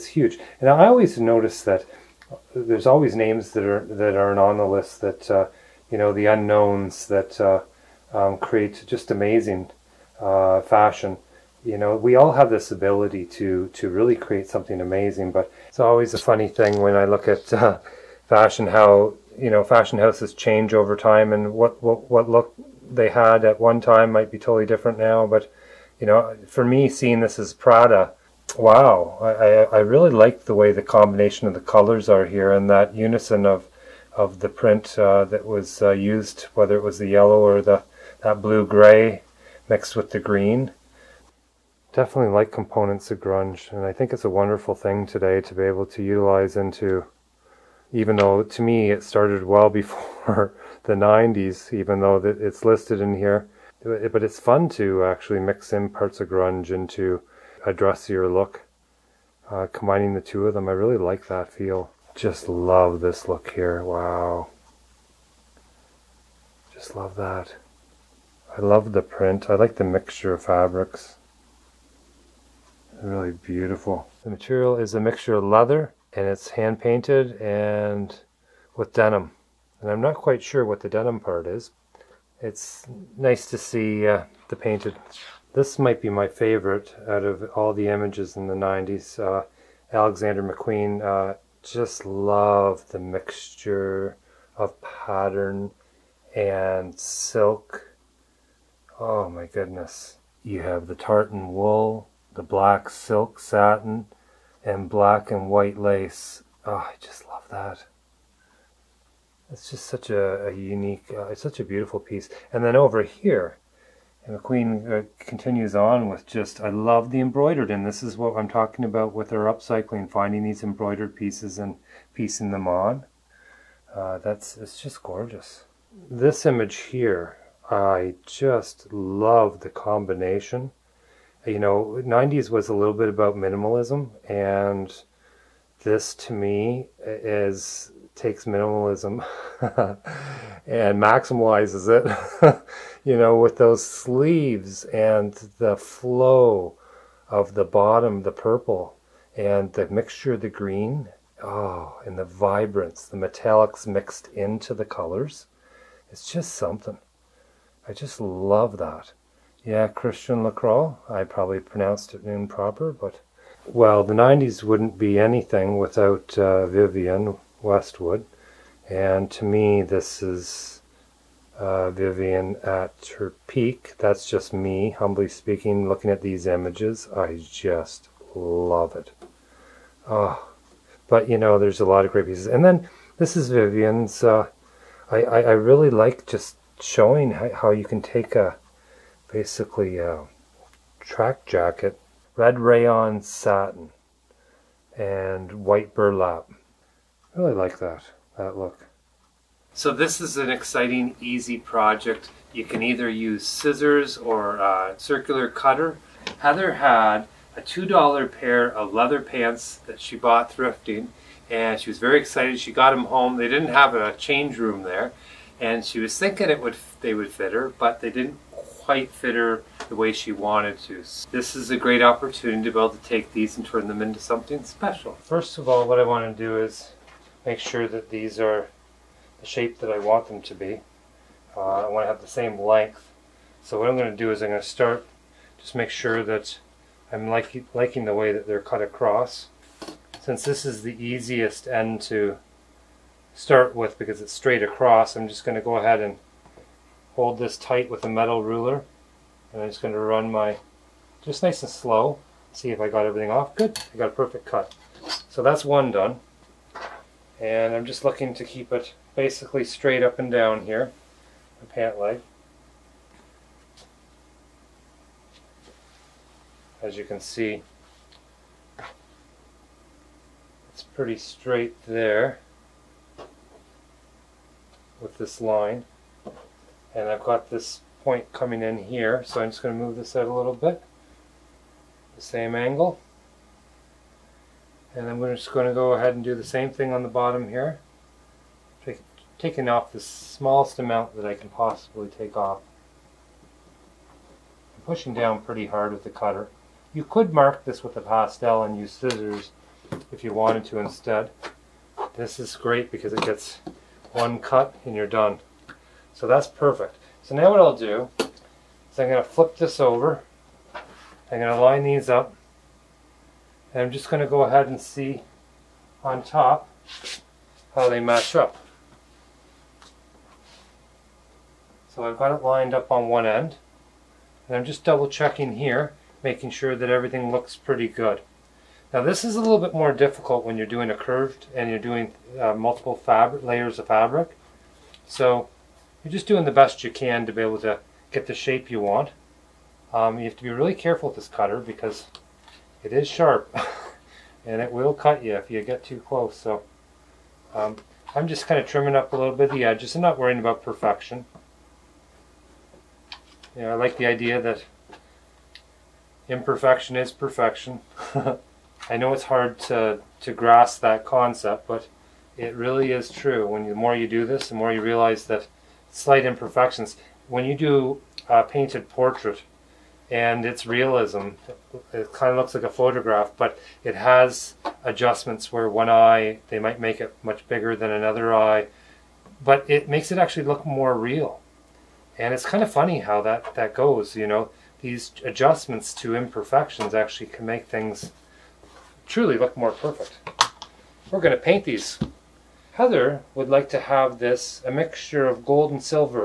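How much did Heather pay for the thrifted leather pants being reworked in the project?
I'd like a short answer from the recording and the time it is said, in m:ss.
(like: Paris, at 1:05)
$2, at 3:27.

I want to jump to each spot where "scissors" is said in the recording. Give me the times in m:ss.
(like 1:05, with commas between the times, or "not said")
3:23, 4:58.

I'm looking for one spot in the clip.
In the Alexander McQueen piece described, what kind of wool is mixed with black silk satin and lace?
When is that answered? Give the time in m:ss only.
1:40.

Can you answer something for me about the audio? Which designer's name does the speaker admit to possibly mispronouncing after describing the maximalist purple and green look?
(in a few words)
Christian Lacroix.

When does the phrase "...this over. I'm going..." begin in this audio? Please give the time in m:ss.
5:09.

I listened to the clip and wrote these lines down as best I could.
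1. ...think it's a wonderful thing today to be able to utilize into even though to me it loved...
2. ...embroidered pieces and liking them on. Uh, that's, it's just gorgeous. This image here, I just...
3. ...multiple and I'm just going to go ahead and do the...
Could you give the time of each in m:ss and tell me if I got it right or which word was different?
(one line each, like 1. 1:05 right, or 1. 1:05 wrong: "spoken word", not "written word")
1. 0:43 wrong: "started", not "loved"
2. 2:00 wrong: "piecing", not "liking"
3. 4:42 wrong: "angle", not "multiple".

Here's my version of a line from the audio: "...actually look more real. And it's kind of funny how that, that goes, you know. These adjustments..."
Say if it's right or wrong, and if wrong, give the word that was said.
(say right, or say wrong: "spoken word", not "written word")
right.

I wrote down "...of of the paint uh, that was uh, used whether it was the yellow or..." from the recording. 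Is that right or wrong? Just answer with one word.
wrong.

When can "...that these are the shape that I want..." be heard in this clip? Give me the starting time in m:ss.
3:47.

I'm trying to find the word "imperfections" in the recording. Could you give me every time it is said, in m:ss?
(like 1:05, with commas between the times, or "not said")
5:56, 6:06, 6:26.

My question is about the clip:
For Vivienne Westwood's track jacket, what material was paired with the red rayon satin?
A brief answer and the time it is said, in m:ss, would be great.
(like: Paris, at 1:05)
White burlap, at 3:15.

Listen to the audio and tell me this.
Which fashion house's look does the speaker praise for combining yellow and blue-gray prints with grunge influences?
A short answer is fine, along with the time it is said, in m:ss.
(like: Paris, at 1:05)
Prada, at 0:27.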